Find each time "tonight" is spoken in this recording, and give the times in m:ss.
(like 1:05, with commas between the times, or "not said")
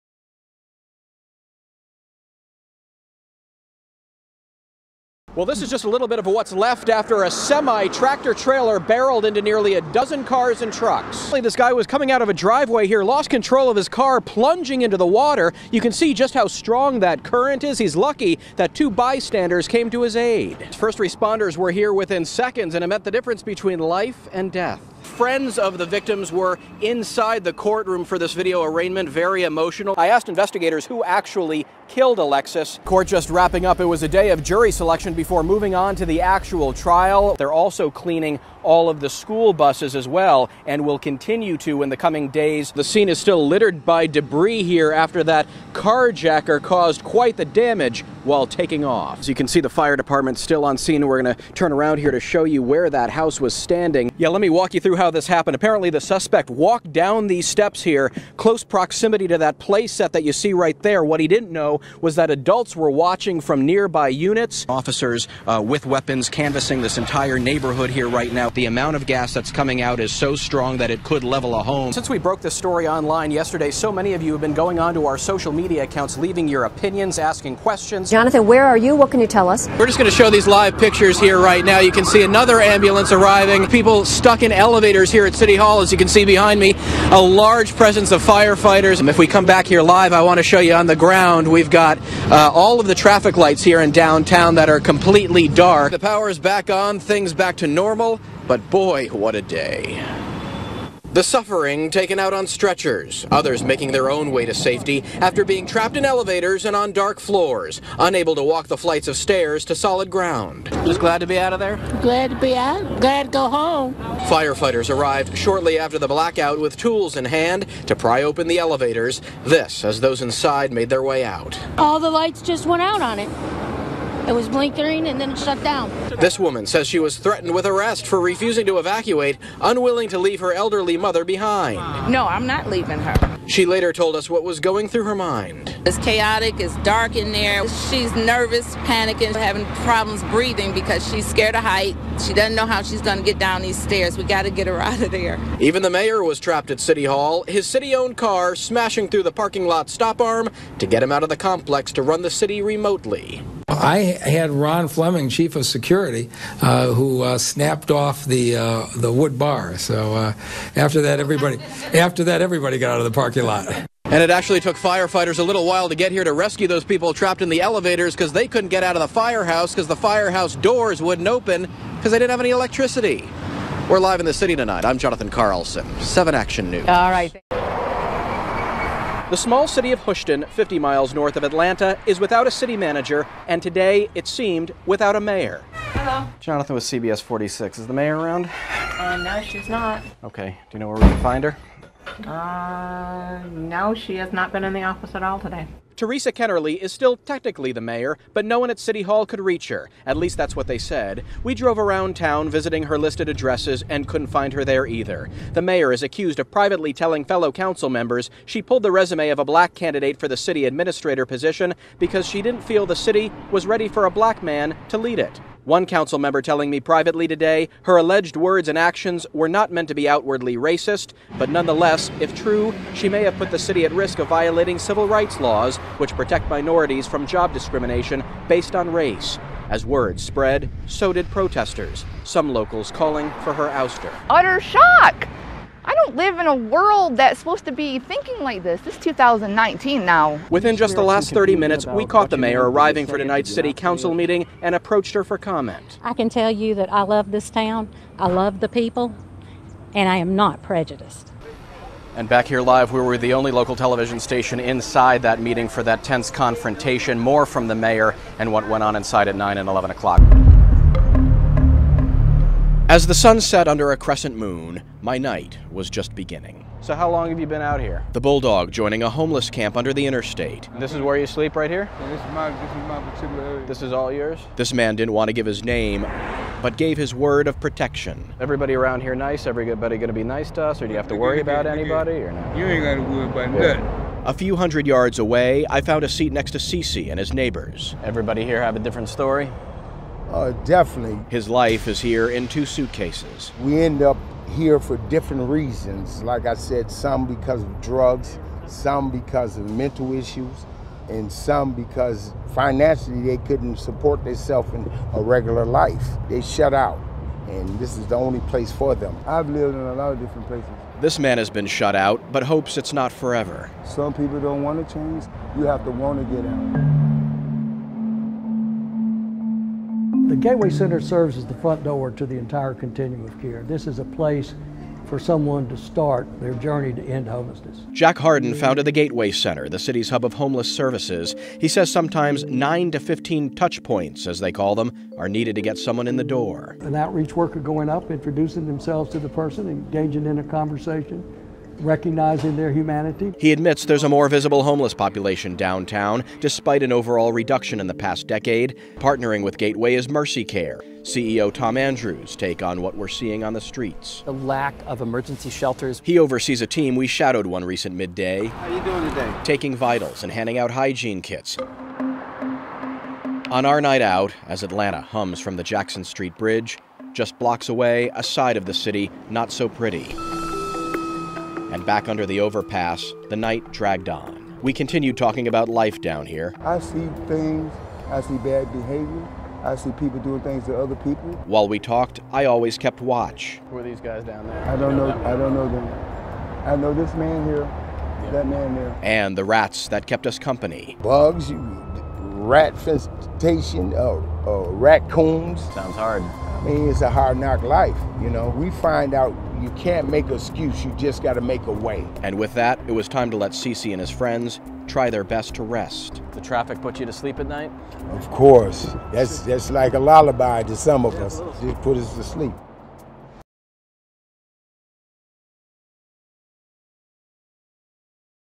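2:54, 4:03.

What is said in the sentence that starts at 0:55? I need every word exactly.
Apparently the suspect walked down these steps here, close proximity to that play set that you see right there.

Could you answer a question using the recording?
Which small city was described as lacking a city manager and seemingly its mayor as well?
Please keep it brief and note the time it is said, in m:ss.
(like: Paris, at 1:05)
Hoschton, at 3:00.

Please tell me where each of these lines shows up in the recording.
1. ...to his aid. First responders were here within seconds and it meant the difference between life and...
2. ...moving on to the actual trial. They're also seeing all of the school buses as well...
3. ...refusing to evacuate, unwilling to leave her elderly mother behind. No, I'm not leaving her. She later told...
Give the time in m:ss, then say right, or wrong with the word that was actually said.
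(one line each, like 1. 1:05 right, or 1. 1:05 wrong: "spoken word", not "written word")
1. 0:19 right
2. 0:35 wrong: "cleaning", not "seeing"
3. 2:08 right.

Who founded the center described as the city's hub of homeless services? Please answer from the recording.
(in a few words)
Jack Hardin.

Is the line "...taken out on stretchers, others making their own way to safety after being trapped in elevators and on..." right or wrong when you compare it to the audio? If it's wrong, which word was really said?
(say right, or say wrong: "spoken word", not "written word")
right.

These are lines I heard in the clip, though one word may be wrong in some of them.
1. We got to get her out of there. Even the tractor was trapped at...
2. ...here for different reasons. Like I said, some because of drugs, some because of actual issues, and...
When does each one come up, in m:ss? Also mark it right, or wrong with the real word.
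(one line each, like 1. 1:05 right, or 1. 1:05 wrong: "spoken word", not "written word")
1. 2:24 wrong: "mayor", not "tractor"
2. 4:54 wrong: "mental", not "actual".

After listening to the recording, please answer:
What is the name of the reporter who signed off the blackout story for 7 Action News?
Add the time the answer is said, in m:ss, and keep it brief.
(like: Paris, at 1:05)
Jonathan Carlson, at 2:54.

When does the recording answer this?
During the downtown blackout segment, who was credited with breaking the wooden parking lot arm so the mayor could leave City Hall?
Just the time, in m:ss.
2:34.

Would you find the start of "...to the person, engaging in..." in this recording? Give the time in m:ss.
5:39.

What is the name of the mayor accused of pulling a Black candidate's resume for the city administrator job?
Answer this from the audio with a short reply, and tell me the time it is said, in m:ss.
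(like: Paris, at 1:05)
Theresa Kenerly, at 3:16.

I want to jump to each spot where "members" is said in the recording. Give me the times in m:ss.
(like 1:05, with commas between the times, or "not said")
3:27, 3:36.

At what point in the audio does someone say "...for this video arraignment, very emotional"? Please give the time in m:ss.
0:28.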